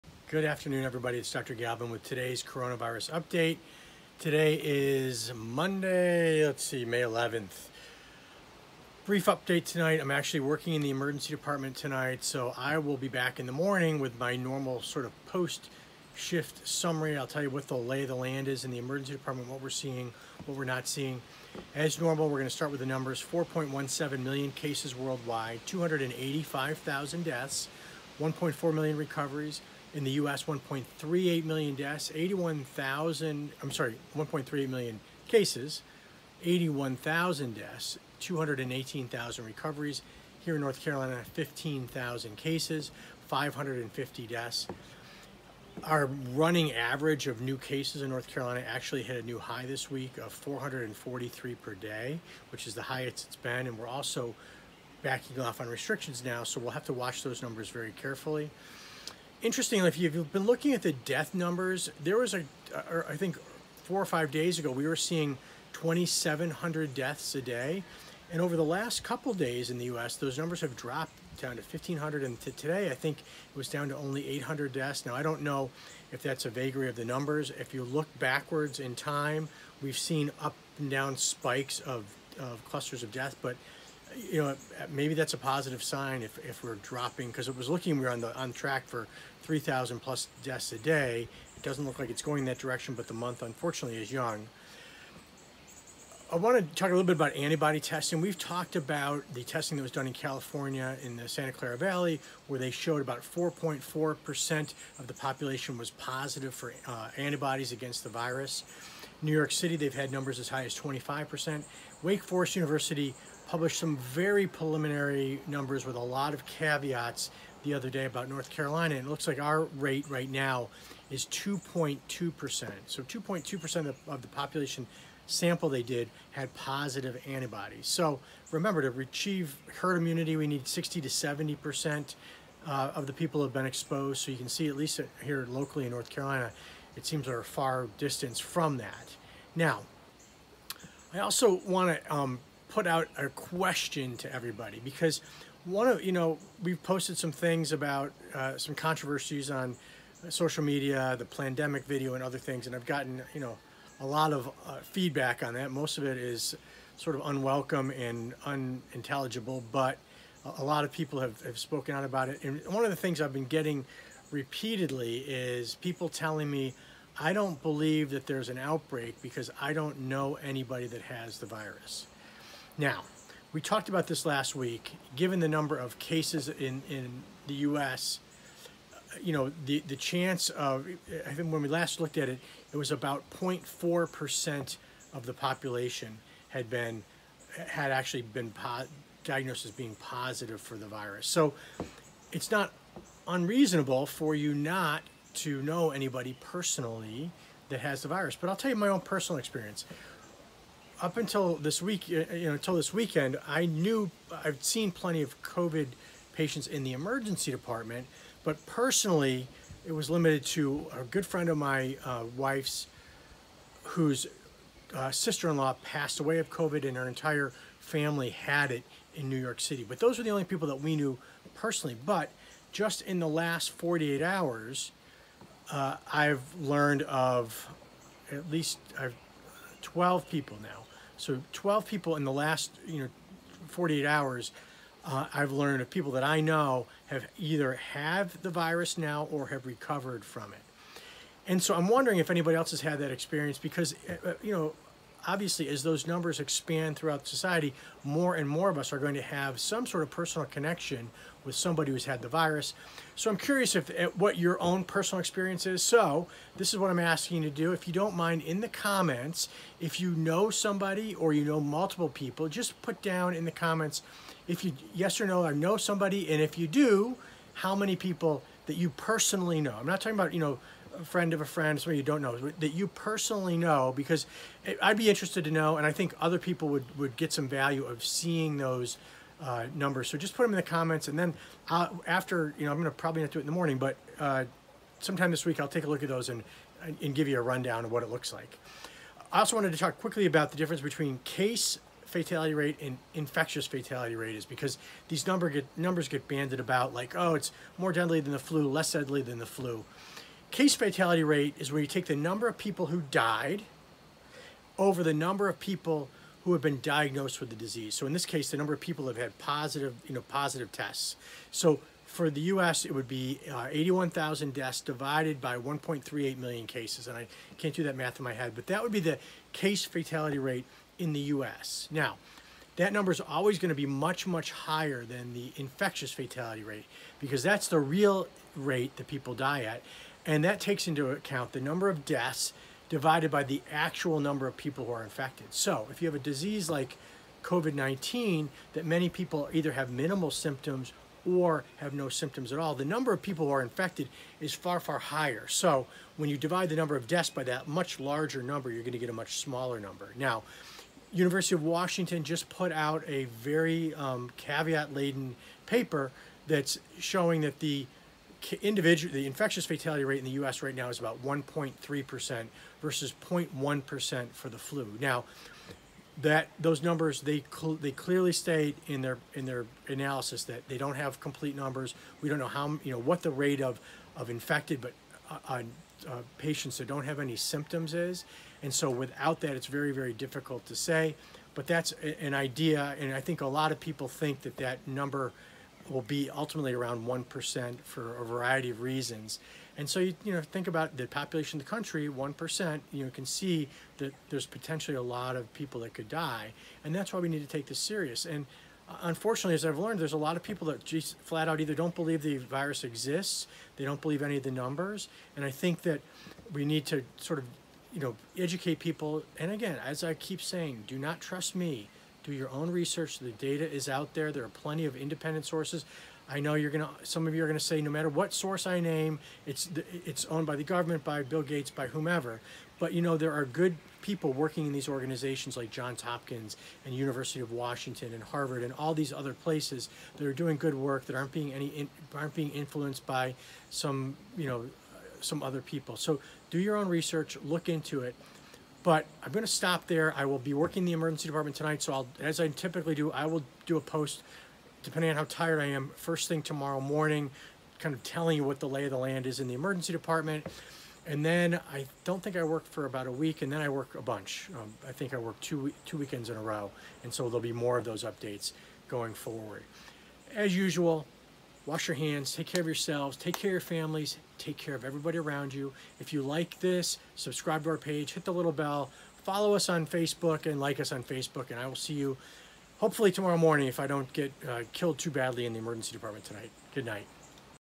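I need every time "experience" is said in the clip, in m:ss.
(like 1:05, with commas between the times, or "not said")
3:19, 4:03, 4:15.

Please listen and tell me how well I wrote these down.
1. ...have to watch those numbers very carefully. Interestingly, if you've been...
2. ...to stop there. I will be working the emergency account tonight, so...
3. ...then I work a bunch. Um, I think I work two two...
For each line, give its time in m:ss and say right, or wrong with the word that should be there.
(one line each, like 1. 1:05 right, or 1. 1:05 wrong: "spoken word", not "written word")
1. 0:56 right
2. 7:19 wrong: "department", not "account"
3. 7:33 right.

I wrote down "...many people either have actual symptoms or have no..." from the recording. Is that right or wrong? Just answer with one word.
wrong.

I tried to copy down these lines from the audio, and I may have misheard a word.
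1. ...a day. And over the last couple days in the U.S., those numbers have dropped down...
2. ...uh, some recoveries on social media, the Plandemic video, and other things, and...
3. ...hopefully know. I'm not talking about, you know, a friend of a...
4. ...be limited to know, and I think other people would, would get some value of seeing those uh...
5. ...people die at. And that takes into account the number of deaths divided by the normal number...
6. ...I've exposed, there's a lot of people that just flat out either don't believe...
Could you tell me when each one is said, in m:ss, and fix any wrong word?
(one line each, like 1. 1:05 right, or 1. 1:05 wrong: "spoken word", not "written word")
1. 1:07 right
2. 2:28 wrong: "controversies", not "recoveries"
3. 4:28 wrong: "personally", not "hopefully"
4. 4:34 wrong: "interested", not "limited"
5. 5:29 wrong: "actual", not "normal"
6. 6:39 wrong: "learned", not "exposed".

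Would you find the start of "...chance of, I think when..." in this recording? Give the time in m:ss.
2:59.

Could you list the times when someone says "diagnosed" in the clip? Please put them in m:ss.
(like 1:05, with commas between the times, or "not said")
3:09, 5:06.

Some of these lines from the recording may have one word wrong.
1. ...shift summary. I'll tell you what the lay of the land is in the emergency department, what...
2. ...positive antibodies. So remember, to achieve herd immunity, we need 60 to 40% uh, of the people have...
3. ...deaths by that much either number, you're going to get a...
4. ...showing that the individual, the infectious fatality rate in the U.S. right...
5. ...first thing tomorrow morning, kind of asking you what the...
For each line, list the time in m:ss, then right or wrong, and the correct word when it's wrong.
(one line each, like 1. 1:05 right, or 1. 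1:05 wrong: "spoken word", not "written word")
1. 0:16 right
2. 2:06 wrong: "70", not "40"
3. 5:47 wrong: "larger", not "either"
4. 5:56 right
5. 7:25 wrong: "telling", not "asking".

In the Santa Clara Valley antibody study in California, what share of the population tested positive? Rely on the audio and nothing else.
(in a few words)
4.4%.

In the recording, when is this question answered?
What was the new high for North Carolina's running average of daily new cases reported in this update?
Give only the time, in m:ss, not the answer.
0:50.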